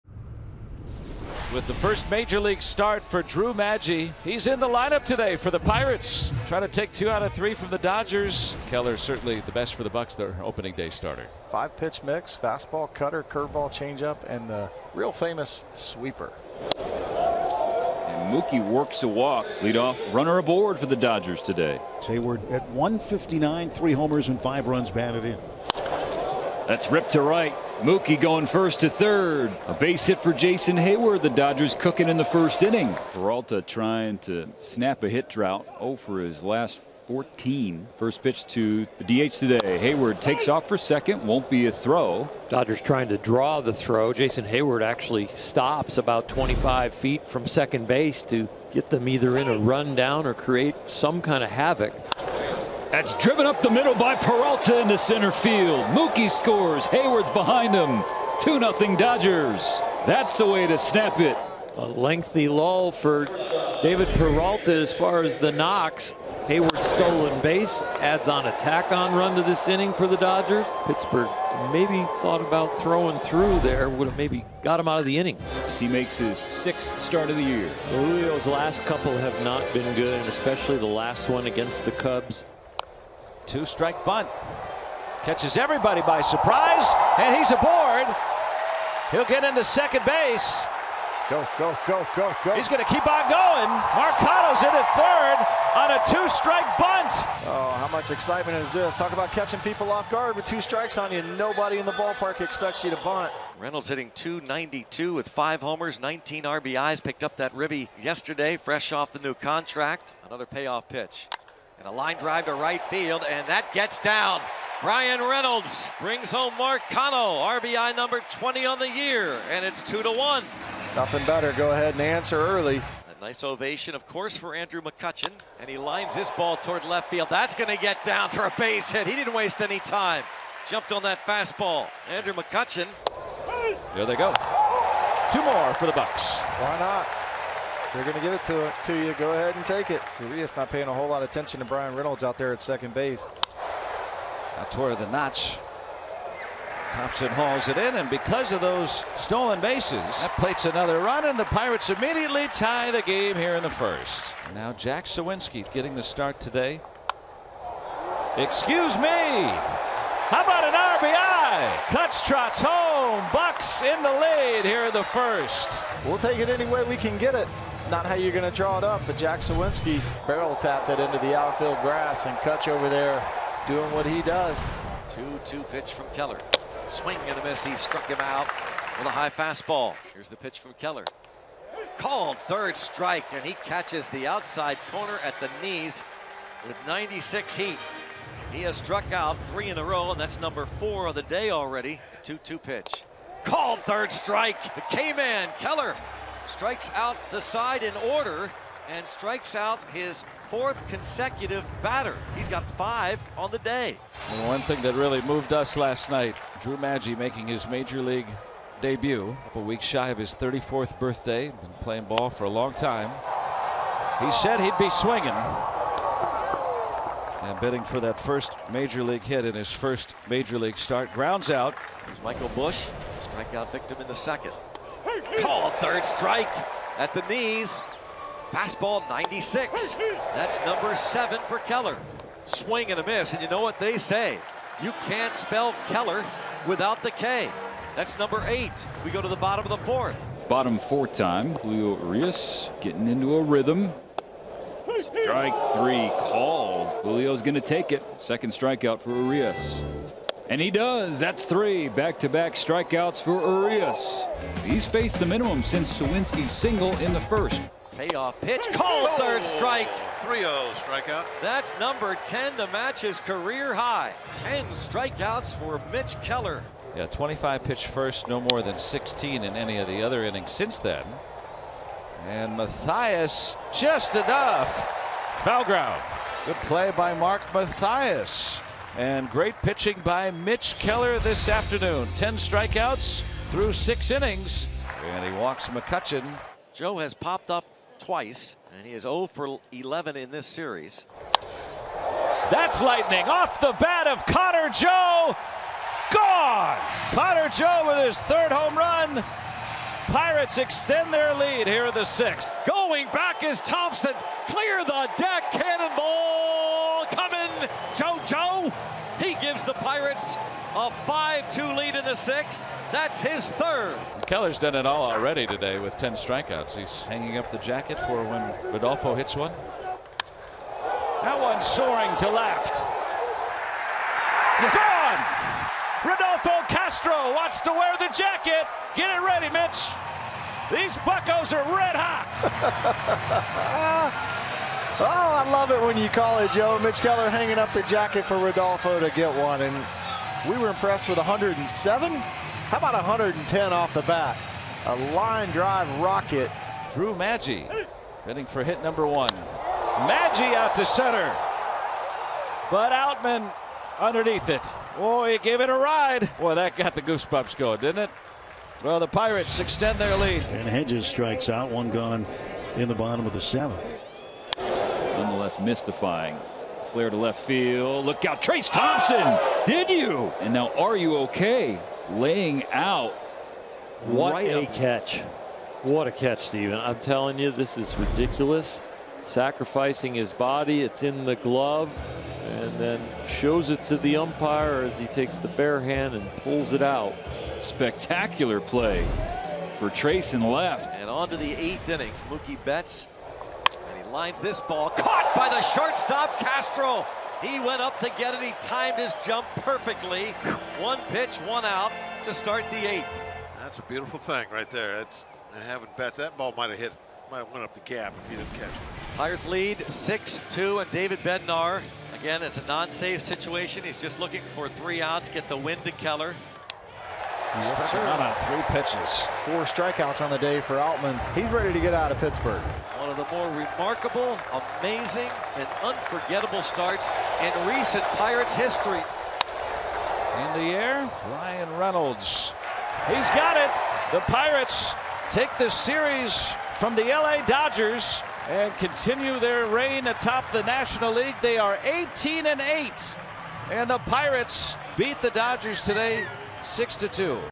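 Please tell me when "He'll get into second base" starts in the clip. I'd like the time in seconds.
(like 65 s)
89 s.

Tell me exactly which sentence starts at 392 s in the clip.
Mookie Betts Lines this ball, caught by the shortstop Castro.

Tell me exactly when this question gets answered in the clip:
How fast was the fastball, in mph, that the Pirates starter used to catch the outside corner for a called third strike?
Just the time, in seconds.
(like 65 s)
186 s.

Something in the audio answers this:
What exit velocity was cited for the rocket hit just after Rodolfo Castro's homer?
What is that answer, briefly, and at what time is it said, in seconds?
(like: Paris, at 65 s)
110, at 342 s.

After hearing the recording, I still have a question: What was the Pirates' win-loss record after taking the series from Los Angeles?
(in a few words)
18-8.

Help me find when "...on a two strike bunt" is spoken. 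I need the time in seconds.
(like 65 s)
95 s.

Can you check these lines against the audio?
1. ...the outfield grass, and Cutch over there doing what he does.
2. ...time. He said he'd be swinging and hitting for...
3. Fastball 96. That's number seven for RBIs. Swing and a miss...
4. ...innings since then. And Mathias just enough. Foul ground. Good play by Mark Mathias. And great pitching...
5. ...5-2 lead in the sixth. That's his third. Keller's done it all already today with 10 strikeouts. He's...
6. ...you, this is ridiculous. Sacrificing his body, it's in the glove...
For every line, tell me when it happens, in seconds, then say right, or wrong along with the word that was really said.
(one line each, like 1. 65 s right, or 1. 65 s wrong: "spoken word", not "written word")
1. 171 s right
2. 212 s wrong: "bidding", not "hitting"
3. 228 s wrong: "Keller", not "RBIs"
4. 270 s right
5. 310 s right
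6. 377 s right.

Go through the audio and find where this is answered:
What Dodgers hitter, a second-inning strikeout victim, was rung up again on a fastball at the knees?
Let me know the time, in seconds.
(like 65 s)
222 s.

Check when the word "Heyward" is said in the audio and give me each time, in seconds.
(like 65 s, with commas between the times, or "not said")
22 s, 30 s, 39 s, 44 s, 56 s, 66 s.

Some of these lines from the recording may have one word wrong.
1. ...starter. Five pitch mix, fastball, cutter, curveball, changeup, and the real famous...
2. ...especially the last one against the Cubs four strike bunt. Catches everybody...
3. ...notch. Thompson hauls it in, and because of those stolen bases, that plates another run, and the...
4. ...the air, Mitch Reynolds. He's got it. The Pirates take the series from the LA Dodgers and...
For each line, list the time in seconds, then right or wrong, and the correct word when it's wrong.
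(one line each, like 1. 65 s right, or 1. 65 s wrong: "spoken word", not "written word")
1. 10 s right
2. 80 s wrong: "two", not "four"
3. 145 s right
4. 430 s wrong: "Bryan", not "Mitch".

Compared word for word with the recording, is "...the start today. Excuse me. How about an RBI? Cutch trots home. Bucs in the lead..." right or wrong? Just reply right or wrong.
right.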